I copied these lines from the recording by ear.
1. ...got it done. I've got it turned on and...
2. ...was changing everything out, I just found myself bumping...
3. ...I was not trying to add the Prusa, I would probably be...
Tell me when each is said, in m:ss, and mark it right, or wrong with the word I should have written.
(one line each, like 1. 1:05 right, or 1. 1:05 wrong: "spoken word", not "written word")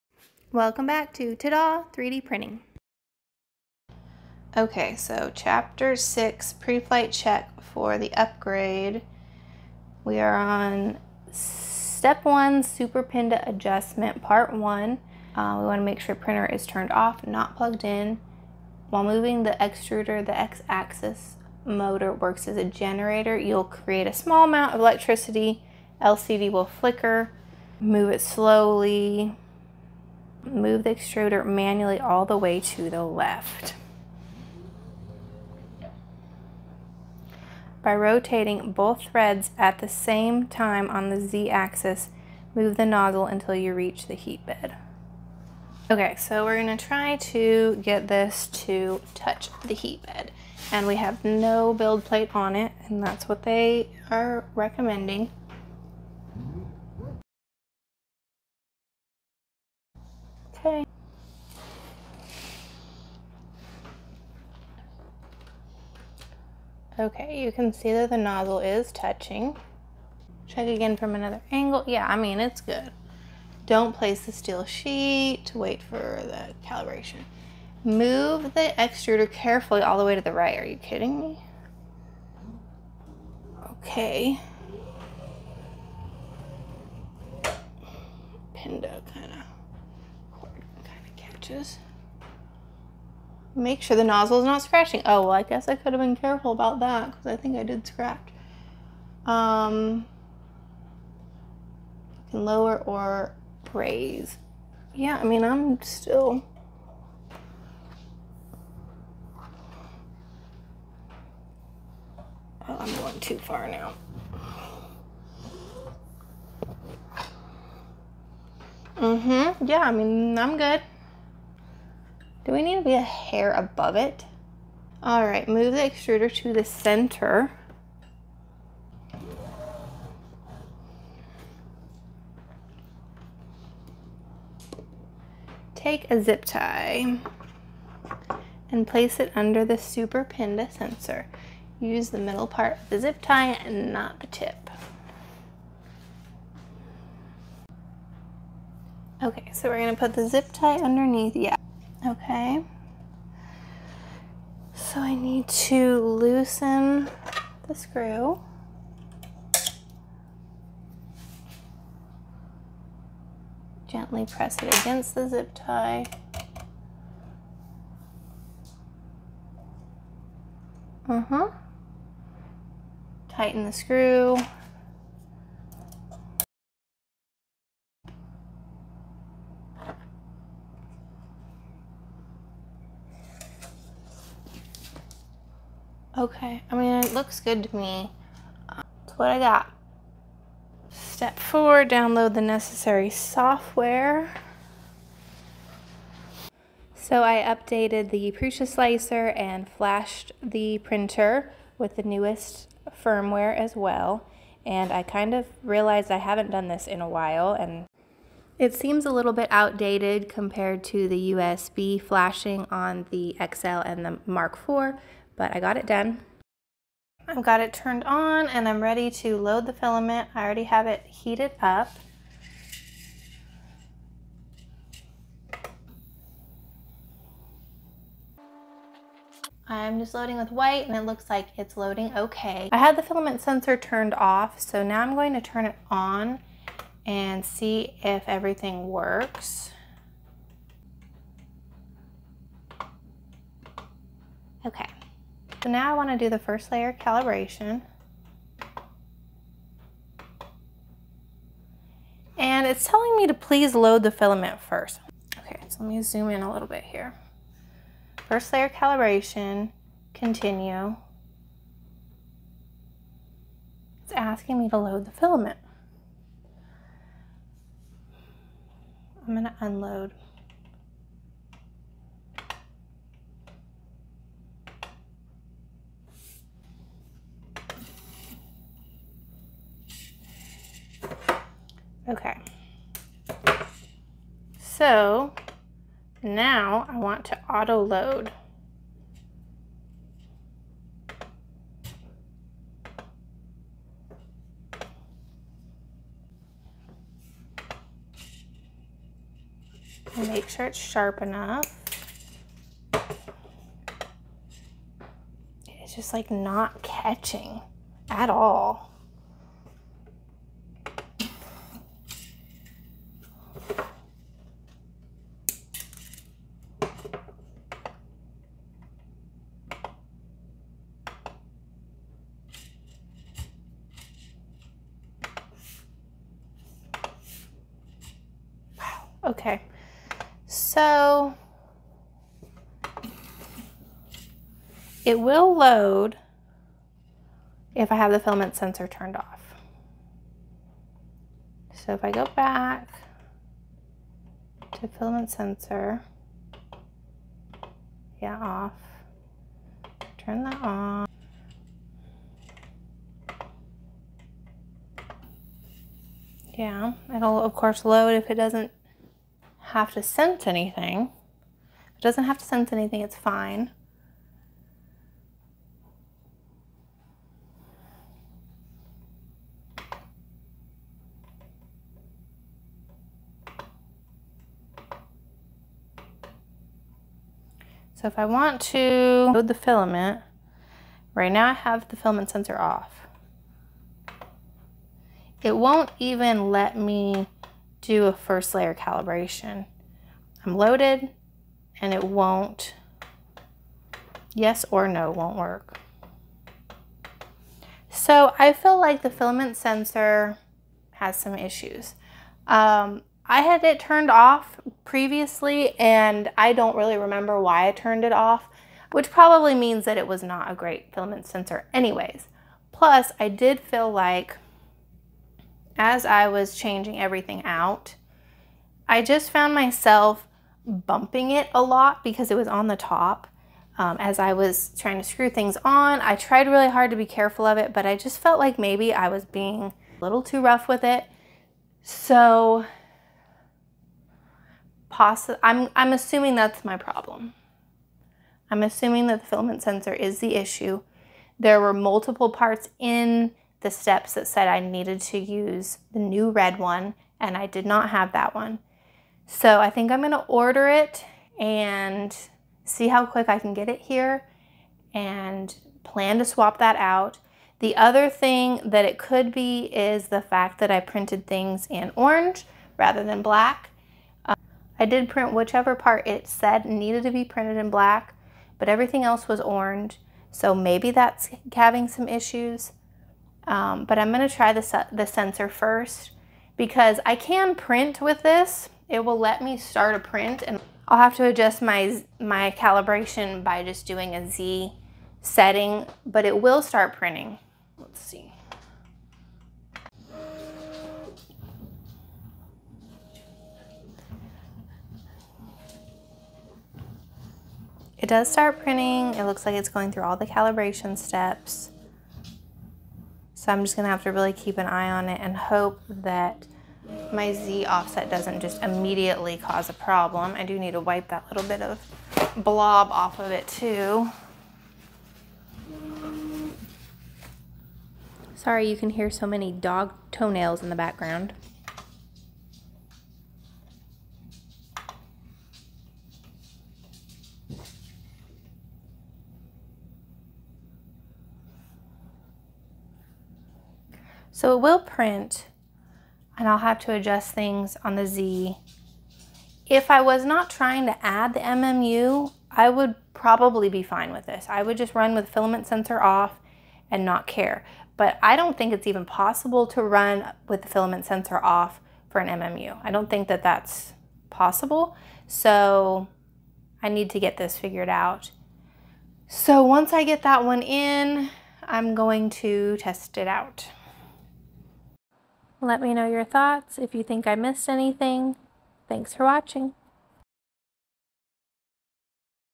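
1. 3:35 right
2. 6:56 right
3. 8:59 wrong: "MMU", not "Prusa".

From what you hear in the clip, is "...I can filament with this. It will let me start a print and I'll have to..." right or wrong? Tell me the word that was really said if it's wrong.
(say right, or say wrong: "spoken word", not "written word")
wrong: "print", not "filament".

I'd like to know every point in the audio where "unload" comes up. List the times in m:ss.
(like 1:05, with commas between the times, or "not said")
4:29.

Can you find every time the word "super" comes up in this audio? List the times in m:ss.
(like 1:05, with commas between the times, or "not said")
0:12, 2:19.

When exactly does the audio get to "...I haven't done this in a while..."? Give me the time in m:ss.
3:26.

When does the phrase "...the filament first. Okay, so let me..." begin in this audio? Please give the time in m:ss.
4:14.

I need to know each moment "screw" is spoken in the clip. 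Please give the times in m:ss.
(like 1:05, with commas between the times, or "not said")
2:37, 2:53, 7:05.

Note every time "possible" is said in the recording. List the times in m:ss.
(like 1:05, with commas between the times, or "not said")
9:09, 9:14.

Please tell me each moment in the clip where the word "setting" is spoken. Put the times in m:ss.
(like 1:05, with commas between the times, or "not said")
8:05.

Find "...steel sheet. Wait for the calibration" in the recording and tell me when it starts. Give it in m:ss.
1:14.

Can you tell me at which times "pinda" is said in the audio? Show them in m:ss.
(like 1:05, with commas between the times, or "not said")
0:13, 1:28, 2:20.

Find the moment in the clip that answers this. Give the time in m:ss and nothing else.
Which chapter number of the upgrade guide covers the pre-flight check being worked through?
0:05.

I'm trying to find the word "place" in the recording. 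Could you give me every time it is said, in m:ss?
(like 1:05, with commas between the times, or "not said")
1:13, 2:18.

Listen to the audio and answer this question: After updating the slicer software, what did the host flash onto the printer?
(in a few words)
newest firmware.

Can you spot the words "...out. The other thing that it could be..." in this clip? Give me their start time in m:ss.
7:36.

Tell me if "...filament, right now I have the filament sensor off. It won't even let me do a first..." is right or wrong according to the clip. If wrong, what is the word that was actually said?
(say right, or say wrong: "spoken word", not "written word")
right.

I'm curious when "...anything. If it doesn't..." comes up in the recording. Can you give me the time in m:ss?
6:00.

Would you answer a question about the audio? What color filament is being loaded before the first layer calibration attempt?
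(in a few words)
white.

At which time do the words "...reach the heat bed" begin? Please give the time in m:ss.
0:43.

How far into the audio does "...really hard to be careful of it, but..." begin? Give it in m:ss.
7:06.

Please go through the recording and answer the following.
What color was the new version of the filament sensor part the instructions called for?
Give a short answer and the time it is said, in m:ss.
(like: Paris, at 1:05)
red, at 7:26.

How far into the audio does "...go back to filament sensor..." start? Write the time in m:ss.
5:42.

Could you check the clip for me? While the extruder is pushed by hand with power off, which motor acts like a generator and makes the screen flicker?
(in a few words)
x-axis motor.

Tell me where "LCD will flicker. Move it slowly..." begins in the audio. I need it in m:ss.
0:26.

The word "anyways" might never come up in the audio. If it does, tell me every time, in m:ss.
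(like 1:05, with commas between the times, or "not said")
6:51.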